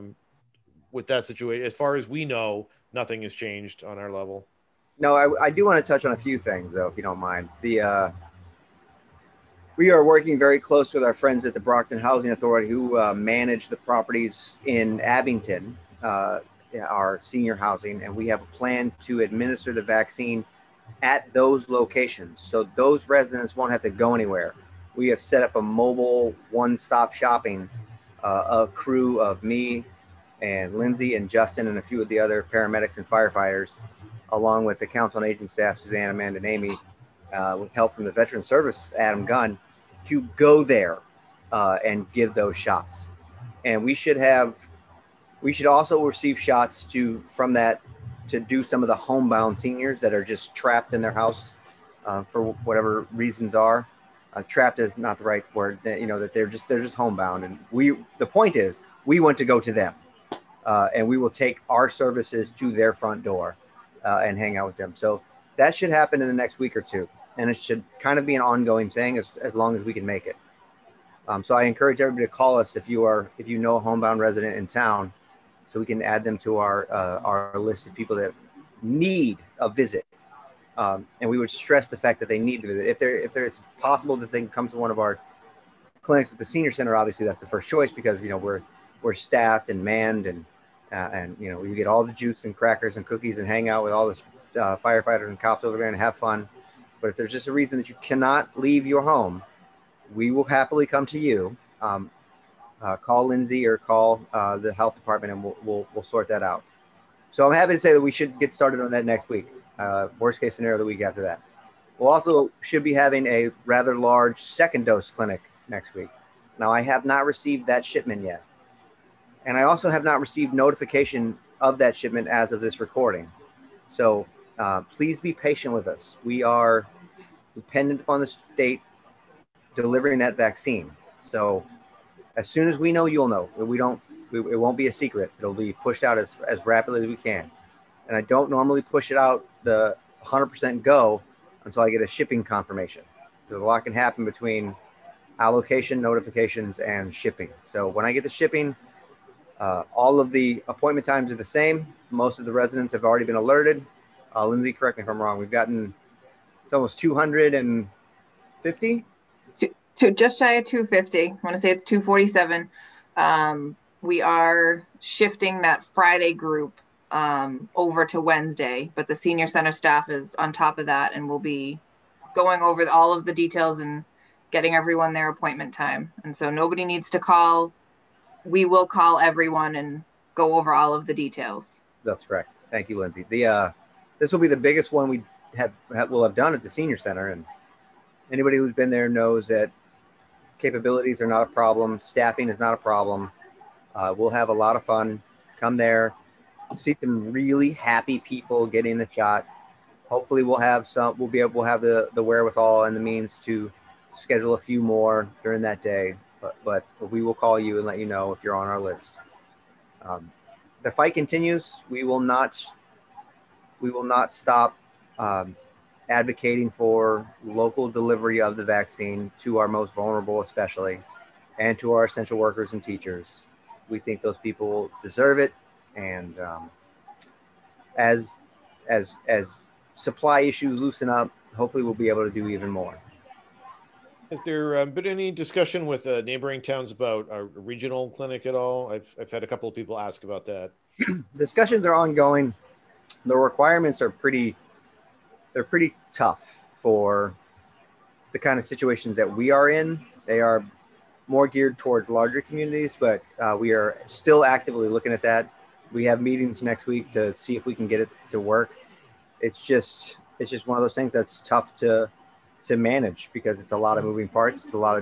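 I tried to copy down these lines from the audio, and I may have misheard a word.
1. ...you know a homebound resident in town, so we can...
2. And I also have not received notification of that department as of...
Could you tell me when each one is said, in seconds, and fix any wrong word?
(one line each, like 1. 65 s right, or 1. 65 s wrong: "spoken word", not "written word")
1. 73 s right
2. 119 s wrong: "shipment", not "department".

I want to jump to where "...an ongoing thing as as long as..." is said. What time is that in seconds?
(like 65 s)
68 s.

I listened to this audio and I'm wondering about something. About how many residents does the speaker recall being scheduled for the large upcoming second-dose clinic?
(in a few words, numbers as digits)
247.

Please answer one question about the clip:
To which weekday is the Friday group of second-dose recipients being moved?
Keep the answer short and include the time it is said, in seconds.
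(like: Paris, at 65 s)
Wednesday, at 168 s.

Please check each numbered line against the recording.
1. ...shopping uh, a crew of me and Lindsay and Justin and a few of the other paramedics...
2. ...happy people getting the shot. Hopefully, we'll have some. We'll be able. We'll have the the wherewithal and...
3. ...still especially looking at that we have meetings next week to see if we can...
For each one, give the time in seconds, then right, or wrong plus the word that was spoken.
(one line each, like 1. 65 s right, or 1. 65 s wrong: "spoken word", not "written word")
1. 27 s right
2. 197 s right
3. 254 s wrong: "actively", not "especially".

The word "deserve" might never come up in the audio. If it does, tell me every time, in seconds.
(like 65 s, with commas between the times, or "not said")
225 s.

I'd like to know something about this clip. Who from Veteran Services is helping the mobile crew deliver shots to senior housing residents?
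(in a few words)
Adam Gunn.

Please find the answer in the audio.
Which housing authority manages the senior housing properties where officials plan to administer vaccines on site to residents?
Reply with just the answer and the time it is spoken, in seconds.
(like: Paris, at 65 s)
Brockton Housing Authority, at 11 s.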